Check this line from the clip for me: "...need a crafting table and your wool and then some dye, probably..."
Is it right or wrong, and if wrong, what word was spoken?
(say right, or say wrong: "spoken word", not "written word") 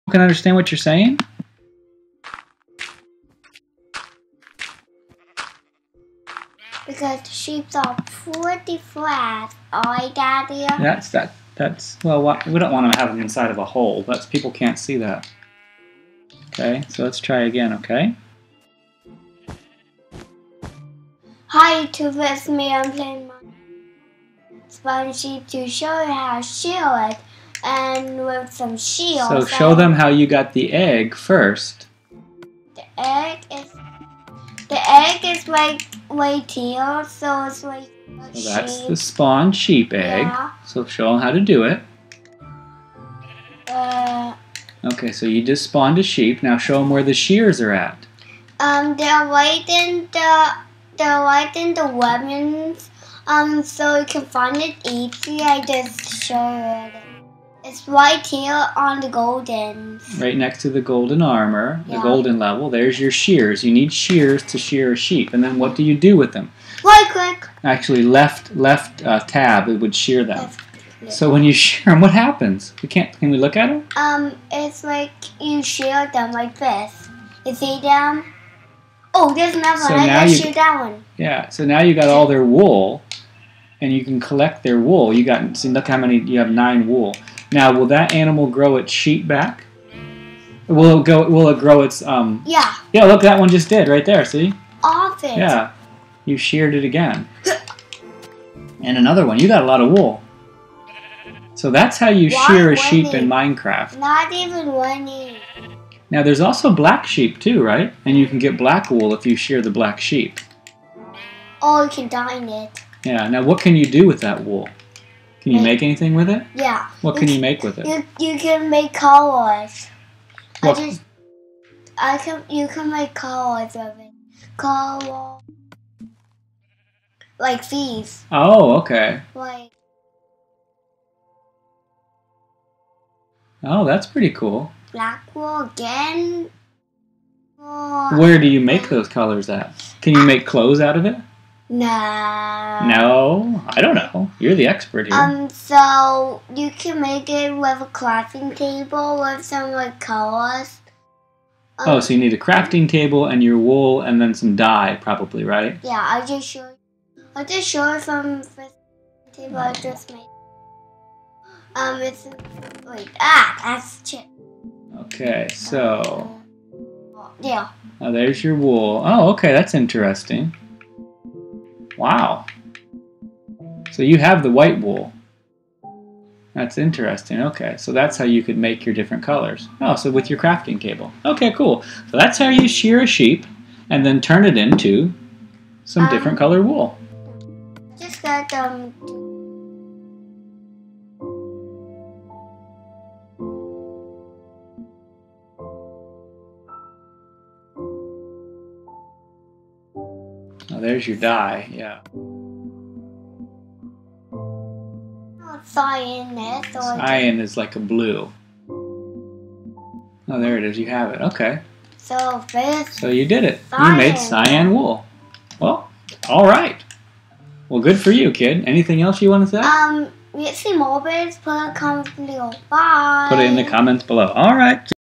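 right.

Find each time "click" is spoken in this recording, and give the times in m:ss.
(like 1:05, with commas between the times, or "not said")
1:07.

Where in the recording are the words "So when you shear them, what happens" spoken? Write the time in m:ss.
1:11.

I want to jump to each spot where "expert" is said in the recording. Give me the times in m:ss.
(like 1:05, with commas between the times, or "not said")
2:24.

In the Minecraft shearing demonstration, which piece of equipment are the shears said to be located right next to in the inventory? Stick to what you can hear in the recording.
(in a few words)
Golden armor.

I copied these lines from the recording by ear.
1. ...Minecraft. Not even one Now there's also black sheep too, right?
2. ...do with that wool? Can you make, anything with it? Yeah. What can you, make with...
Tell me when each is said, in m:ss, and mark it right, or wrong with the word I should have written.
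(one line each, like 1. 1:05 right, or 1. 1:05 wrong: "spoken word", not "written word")
1. 1:43 right
2. 1:53 right.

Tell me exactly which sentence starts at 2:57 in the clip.
Okay, so that's how you could make your different colors.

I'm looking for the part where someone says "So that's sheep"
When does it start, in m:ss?
0:38.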